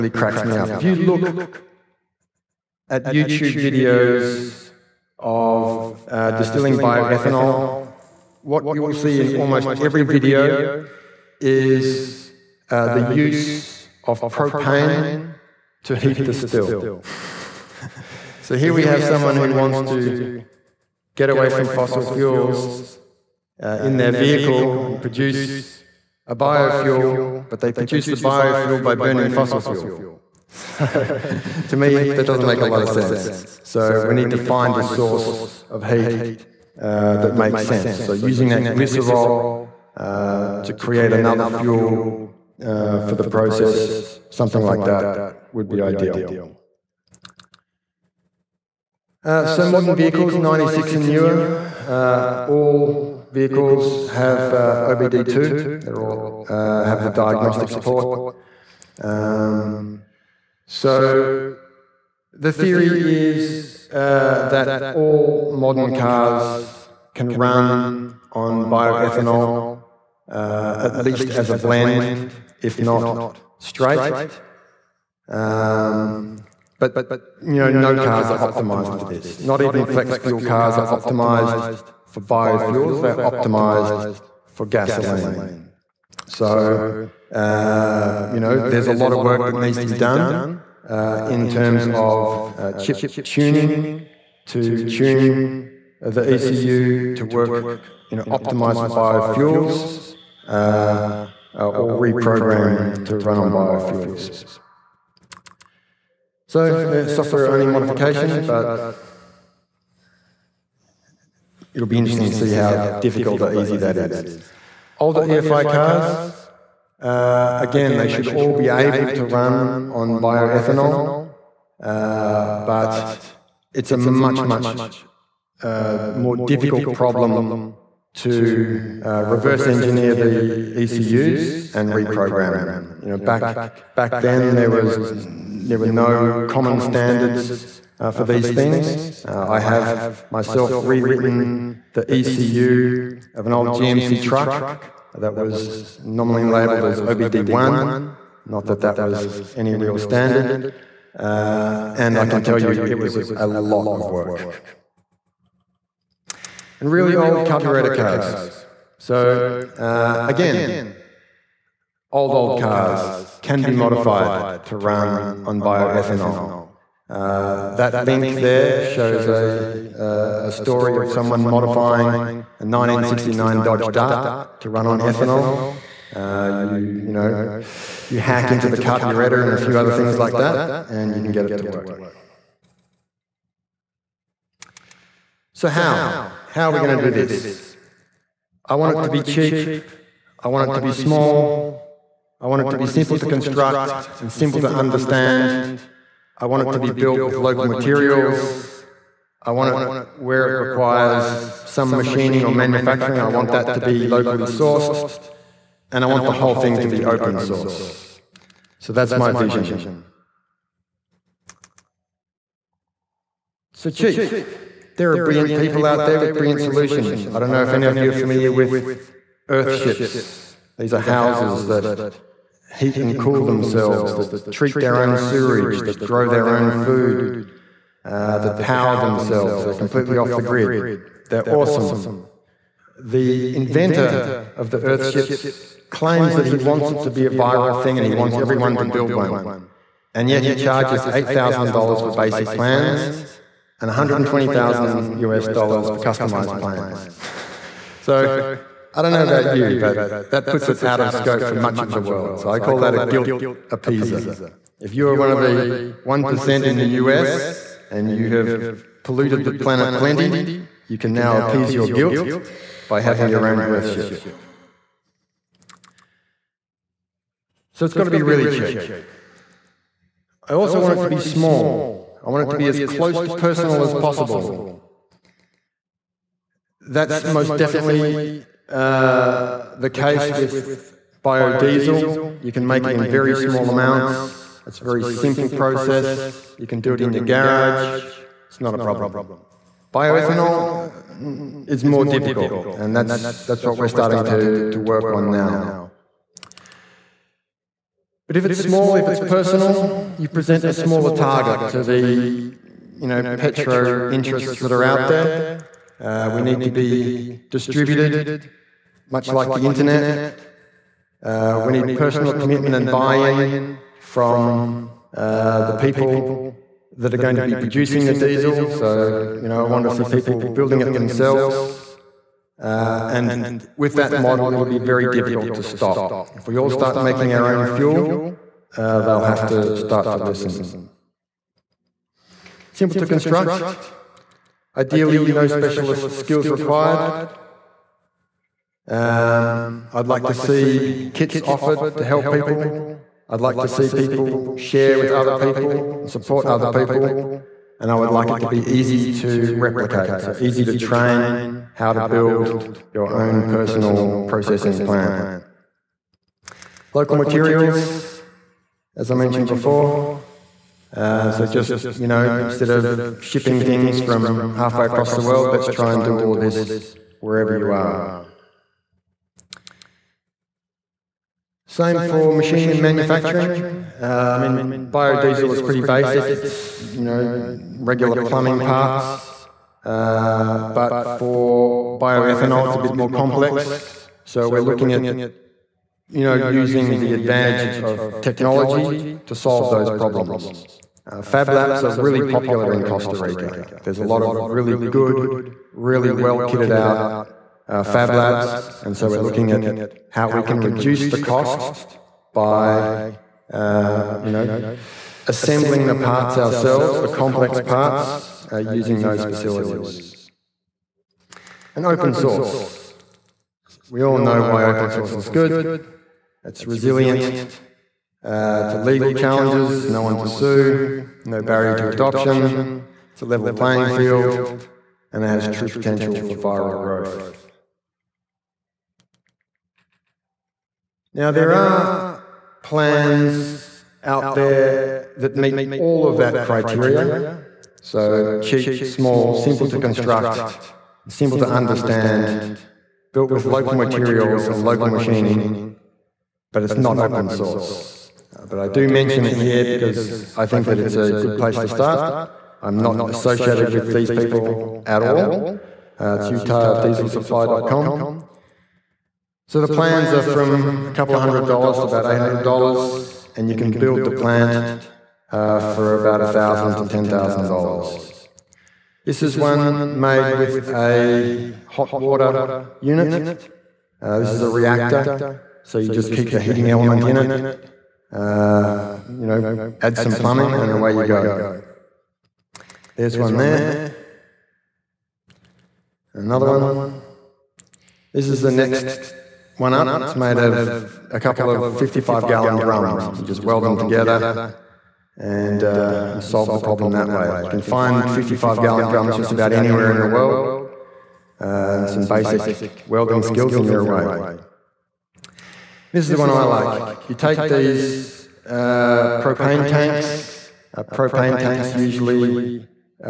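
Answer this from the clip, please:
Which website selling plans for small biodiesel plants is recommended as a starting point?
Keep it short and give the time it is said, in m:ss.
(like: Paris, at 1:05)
utahdieselsupply.com, at 7:36.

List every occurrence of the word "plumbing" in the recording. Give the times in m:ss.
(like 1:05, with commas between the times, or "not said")
6:18, 8:00.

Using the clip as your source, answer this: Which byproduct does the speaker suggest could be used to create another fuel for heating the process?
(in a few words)
glycerol.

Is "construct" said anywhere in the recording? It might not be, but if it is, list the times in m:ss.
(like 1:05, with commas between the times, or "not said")
3:13, 5:33, 7:19.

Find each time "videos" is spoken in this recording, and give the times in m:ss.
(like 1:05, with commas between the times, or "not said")
0:03, 0:10.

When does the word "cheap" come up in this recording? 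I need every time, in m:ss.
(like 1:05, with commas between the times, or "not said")
3:09, 3:33, 4:28, 7:18.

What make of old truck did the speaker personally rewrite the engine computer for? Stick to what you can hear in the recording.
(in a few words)
GMC.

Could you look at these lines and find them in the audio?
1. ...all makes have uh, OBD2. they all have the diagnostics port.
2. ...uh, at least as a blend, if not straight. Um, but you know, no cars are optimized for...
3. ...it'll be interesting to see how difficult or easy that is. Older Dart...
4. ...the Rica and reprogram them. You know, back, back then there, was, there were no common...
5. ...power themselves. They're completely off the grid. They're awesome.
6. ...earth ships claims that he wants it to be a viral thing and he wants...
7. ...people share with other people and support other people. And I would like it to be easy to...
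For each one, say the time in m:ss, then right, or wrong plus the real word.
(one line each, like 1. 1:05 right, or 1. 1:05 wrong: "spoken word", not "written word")
1. 0:52 wrong: "vehicles", not "makes"
2. 1:10 right
3. 1:51 wrong: "EFI", not "Dart"
4. 2:10 wrong: "ECUs", not "Rica"
5. 3:48 right
6. 3:54 right
7. 5:43 right.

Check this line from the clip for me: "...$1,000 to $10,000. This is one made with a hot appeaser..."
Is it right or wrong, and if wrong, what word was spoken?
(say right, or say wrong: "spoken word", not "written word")
wrong: "water", not "appeaser".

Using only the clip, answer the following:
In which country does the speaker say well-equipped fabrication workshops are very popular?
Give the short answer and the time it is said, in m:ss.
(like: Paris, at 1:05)
Costa Rica, at 6:32.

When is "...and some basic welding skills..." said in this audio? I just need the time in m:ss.
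8:21.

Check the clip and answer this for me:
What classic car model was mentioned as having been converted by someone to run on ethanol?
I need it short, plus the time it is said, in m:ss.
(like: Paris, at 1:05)
Dodge Dart, at 2:53.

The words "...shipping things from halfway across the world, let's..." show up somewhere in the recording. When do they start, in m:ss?
6:03.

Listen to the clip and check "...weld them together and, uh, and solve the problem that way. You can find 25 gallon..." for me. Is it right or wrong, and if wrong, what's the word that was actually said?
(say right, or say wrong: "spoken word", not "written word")
wrong: "55", not "25".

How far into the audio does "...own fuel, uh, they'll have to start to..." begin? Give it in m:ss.
5:27.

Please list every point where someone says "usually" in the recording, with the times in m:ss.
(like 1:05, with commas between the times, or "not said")
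8:31.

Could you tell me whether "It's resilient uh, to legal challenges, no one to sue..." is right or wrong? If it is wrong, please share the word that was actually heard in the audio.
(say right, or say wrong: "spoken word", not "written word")
right.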